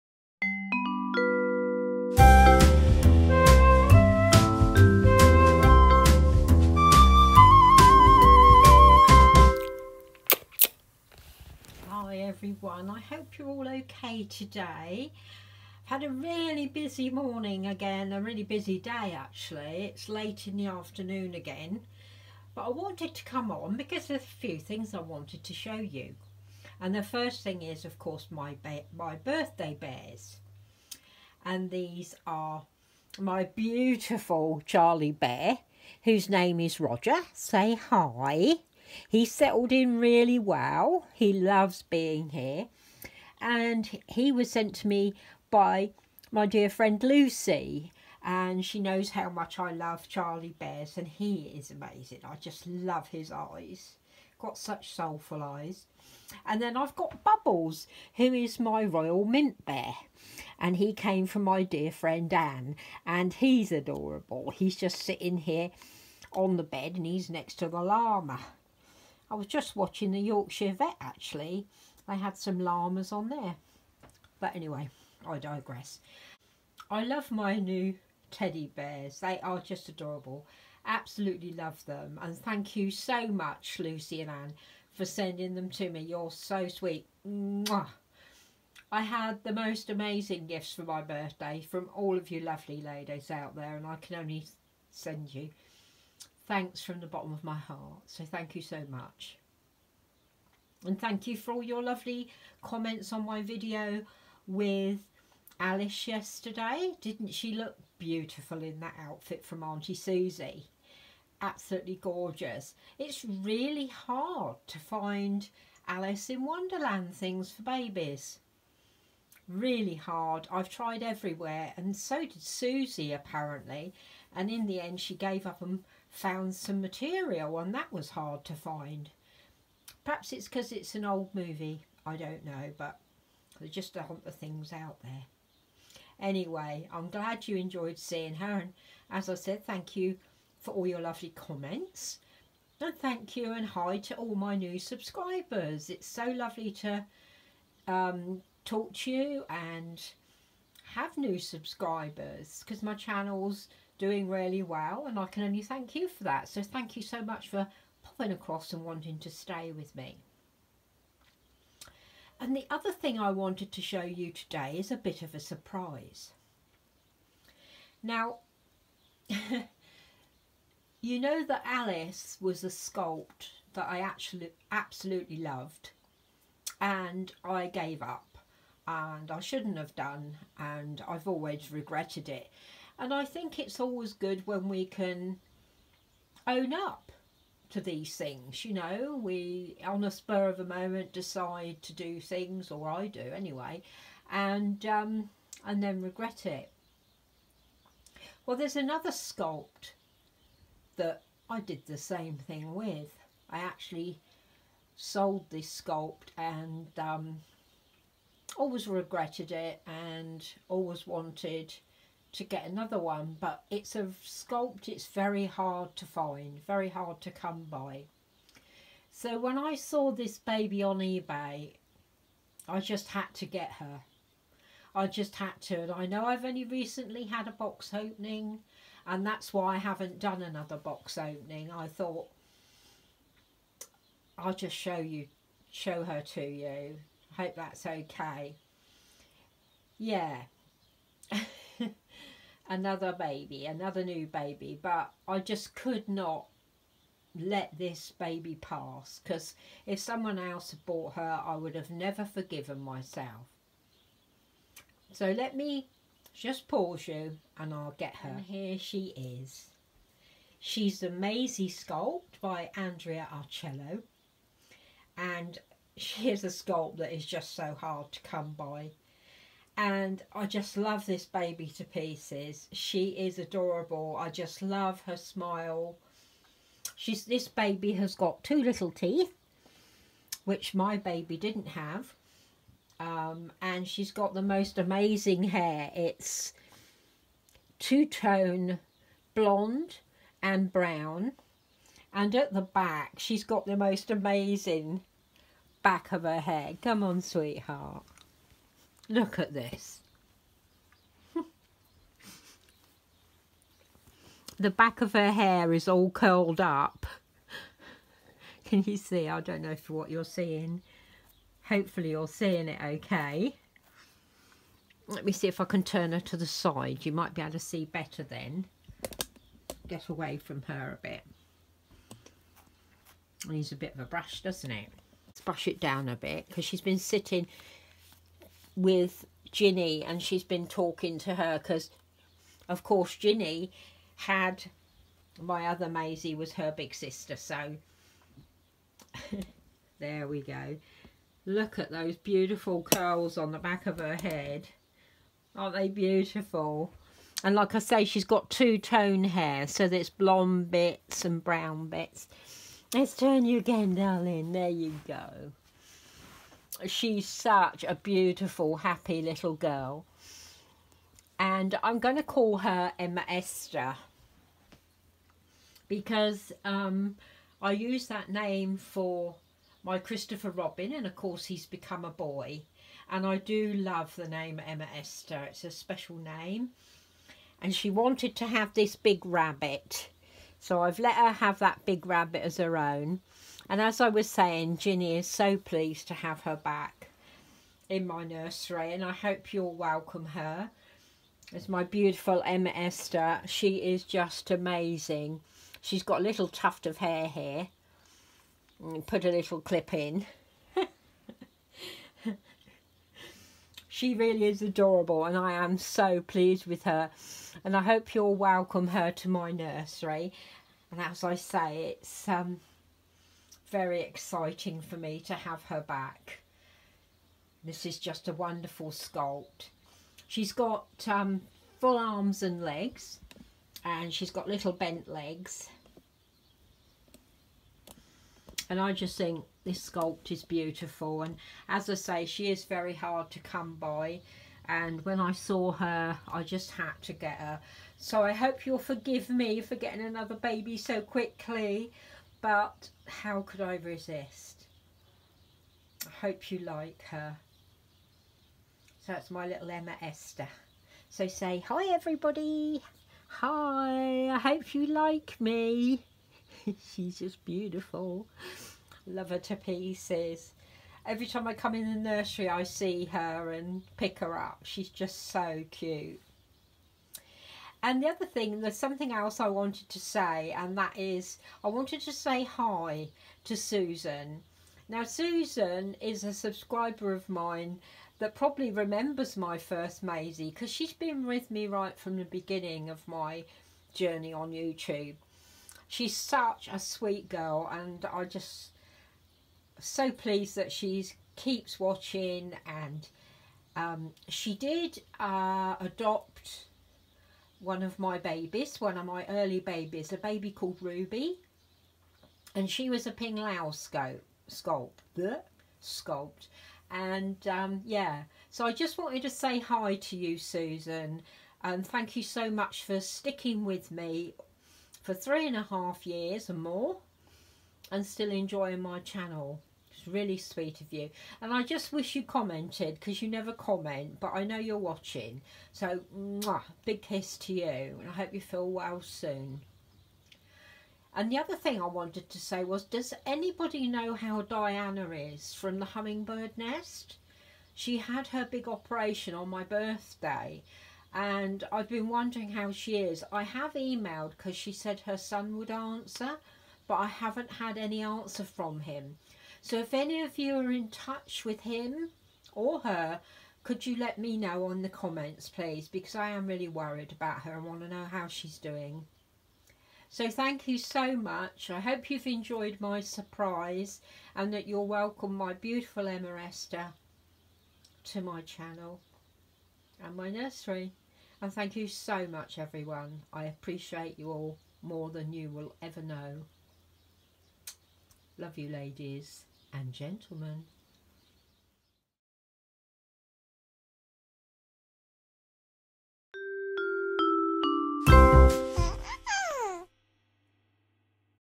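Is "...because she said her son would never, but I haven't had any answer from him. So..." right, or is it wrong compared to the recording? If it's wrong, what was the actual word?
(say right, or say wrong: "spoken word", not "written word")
wrong: "answer", not "never".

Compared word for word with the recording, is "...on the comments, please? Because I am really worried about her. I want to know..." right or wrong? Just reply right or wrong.
right.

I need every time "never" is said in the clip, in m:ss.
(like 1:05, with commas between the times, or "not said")
4:11, 8:43.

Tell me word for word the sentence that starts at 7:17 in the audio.
So I hope you'll forgive me for getting another baby so quickly but how could I resist?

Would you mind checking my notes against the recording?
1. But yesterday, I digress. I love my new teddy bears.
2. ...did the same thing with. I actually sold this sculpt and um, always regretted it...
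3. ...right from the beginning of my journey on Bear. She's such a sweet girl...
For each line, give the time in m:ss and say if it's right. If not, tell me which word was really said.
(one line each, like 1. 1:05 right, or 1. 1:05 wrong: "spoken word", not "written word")
1. 1:14 wrong: "anyway", not "yesterday"
2. 3:21 right
3. 8:01 wrong: "YouTube", not "Bear".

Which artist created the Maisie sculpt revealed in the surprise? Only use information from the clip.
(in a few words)
Andrea Arcello.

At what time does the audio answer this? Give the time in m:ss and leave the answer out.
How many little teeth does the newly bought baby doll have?
4:38.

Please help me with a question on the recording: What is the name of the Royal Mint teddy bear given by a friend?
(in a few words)
Bubbles.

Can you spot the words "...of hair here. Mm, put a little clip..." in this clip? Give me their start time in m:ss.
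6:36.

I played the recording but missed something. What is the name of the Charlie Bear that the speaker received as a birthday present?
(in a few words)
Roger.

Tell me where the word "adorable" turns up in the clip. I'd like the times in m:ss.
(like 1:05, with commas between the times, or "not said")
1:03, 1:19, 4:33, 6:44.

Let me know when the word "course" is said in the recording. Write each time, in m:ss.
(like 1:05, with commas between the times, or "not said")
0:27, 5:32, 6:11.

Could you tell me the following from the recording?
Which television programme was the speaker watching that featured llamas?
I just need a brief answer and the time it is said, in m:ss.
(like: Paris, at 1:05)
the Yorkshire Vet, at 1:10.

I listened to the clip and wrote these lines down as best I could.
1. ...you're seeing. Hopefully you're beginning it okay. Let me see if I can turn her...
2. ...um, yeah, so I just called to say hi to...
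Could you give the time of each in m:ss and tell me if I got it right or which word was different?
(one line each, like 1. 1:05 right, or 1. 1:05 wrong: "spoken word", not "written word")
1. 5:10 wrong: "seeing", not "beginning"
2. 8:27 wrong: "wanted", not "called".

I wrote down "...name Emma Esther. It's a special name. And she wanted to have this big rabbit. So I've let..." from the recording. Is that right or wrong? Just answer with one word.
right.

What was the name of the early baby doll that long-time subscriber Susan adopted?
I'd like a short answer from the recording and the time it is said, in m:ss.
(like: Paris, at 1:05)
Ruby, at 8:20.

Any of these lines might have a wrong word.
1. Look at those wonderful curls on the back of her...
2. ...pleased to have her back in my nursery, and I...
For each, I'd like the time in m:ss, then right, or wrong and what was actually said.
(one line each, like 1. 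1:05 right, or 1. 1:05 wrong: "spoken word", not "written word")
1. 5:41 wrong: "beautiful", not "wonderful"
2. 6:25 right.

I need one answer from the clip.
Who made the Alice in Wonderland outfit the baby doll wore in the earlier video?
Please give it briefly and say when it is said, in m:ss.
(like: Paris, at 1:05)
Auntie Susie, at 1:49.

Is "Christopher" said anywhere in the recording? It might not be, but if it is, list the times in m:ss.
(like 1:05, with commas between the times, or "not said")
6:09.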